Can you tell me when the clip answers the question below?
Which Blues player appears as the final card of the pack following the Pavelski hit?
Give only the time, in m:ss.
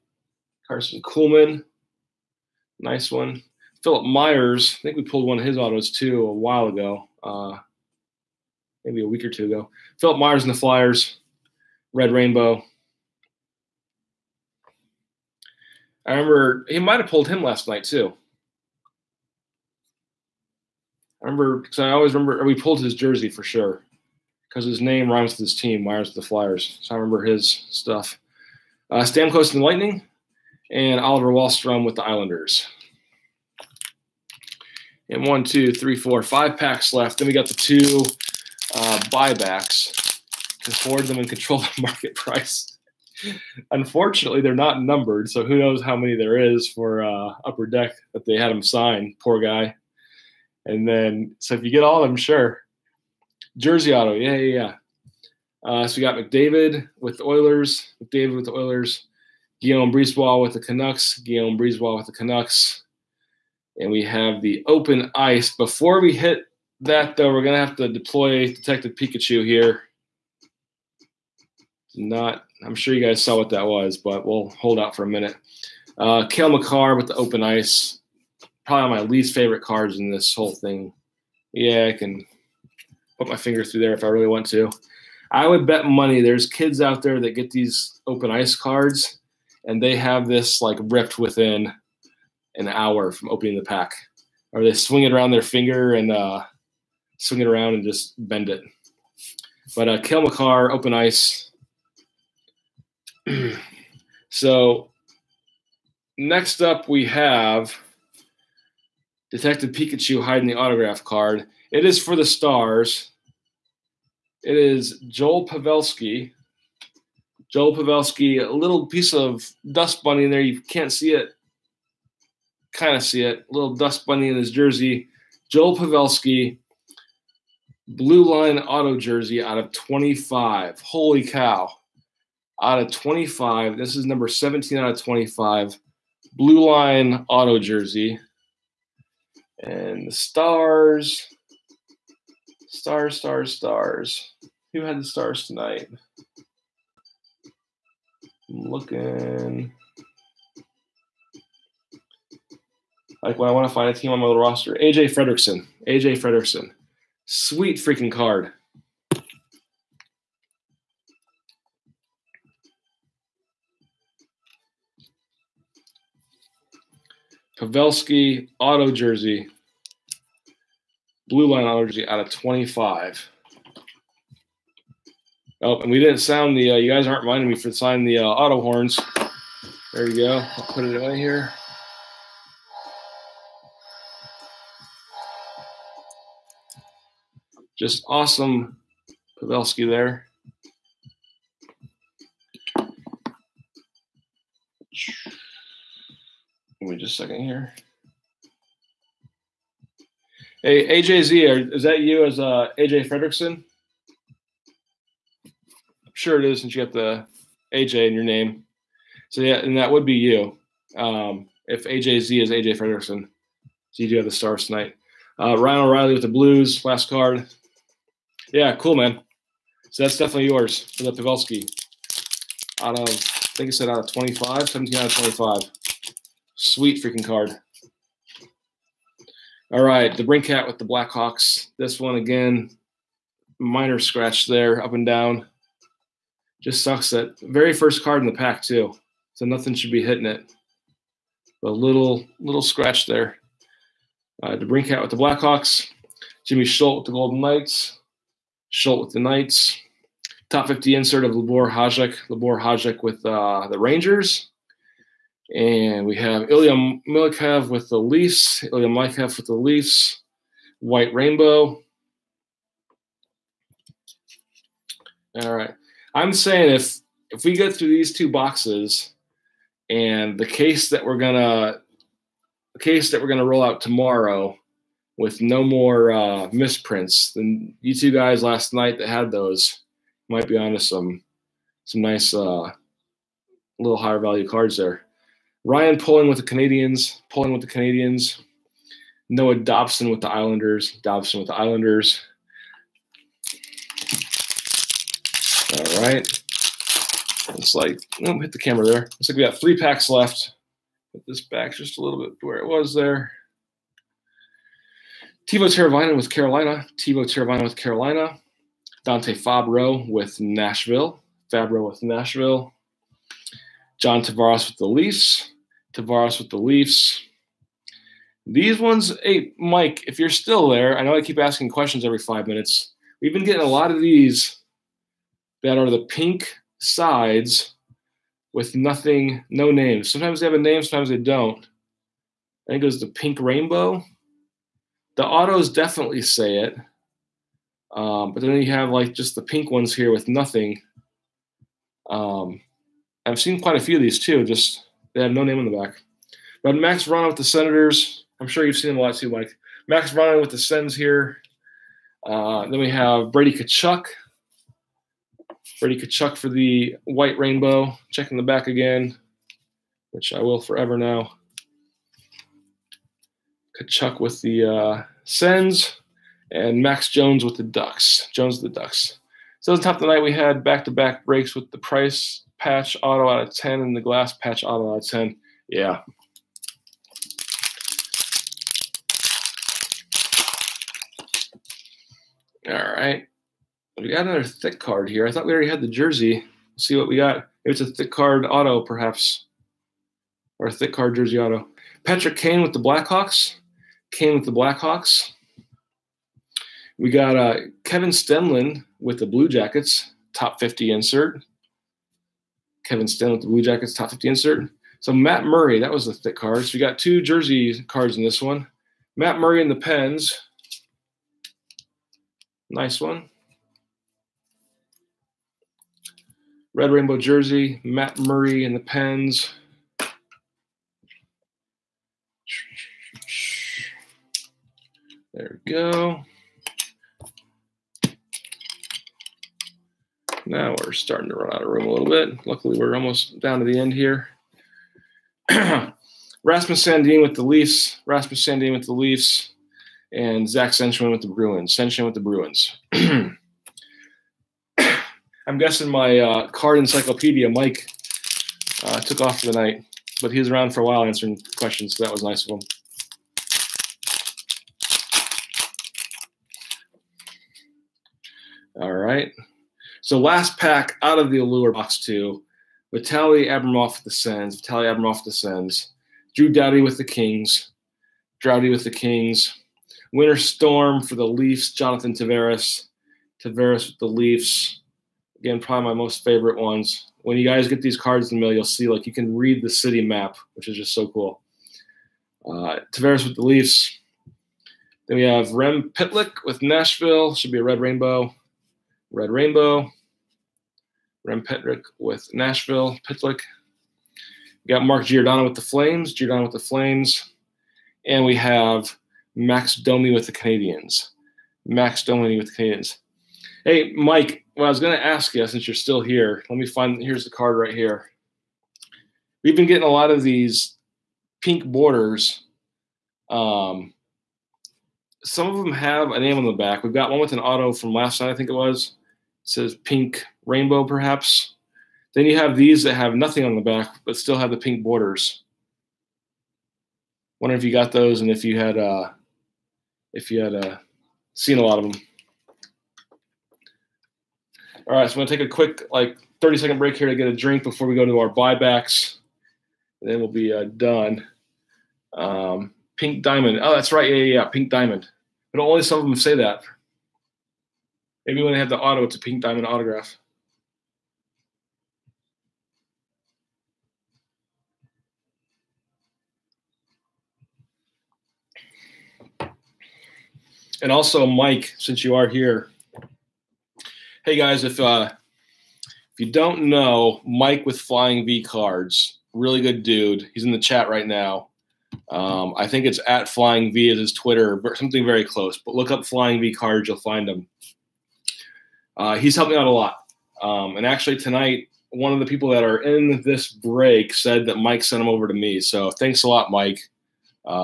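3:35.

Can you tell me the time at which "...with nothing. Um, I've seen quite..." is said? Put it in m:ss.
5:40.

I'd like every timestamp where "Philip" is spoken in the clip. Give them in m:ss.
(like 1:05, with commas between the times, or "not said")
0:03, 0:10.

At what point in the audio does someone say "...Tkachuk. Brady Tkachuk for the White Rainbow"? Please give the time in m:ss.
5:53.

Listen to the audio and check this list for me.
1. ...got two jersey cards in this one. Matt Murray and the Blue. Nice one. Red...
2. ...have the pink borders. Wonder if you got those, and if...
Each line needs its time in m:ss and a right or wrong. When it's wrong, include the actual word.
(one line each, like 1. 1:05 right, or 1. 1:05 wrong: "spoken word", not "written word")
1. 6:46 wrong: "Pens", not "Blue"
2. 8:44 right.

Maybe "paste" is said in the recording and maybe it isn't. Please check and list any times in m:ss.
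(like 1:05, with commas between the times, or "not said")
not said.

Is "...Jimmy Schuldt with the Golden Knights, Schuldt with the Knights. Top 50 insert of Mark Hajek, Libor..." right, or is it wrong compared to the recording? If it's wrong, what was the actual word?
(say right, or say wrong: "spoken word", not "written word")
wrong: "Libor", not "Mark".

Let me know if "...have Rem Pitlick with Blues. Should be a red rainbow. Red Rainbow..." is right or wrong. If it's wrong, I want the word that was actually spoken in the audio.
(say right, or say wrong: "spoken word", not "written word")
wrong: "Nashville", not "Blues".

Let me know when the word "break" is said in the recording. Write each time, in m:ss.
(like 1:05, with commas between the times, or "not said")
6:11, 8:56, 9:43.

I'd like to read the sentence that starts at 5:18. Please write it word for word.
These ones, hey, Mike, if you're still there, I know I keep asking questions every five minutes.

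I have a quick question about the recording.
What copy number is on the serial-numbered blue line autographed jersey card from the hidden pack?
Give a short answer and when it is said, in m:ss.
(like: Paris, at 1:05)
17, at 2:14.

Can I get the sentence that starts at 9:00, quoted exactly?
And then we'll be uh, done.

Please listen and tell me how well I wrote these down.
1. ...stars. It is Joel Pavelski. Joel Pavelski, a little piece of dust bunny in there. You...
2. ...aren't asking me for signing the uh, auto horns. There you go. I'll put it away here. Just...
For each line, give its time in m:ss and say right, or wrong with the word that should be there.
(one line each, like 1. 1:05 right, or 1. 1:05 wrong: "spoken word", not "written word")
1. 1:52 right
2. 2:57 wrong: "minding", not "asking".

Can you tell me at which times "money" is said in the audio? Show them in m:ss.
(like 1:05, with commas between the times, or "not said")
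1:25.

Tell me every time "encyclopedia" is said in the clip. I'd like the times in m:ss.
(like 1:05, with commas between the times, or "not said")
7:26.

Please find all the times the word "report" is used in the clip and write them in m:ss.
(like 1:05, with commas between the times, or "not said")
not said.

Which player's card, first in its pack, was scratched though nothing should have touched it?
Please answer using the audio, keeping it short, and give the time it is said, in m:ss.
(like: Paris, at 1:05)
DeBrincat, at 3:50.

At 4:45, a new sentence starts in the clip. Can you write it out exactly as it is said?
Ryan Poehling with the Canadiens, Poehling with the Canadiens.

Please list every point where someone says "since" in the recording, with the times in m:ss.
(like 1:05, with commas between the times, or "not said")
3:26, 8:25, 9:21.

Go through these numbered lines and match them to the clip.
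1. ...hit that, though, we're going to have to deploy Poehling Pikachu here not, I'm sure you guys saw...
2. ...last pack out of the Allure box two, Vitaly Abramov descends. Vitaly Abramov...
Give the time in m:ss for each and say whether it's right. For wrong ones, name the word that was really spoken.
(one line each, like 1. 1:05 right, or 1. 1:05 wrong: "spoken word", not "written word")
1. 1:06 wrong: "Detective", not "Poehling"
2. 7:40 right.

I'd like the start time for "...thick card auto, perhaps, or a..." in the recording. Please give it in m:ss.
6:27.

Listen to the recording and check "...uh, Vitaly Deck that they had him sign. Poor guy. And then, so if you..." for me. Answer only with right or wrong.
wrong.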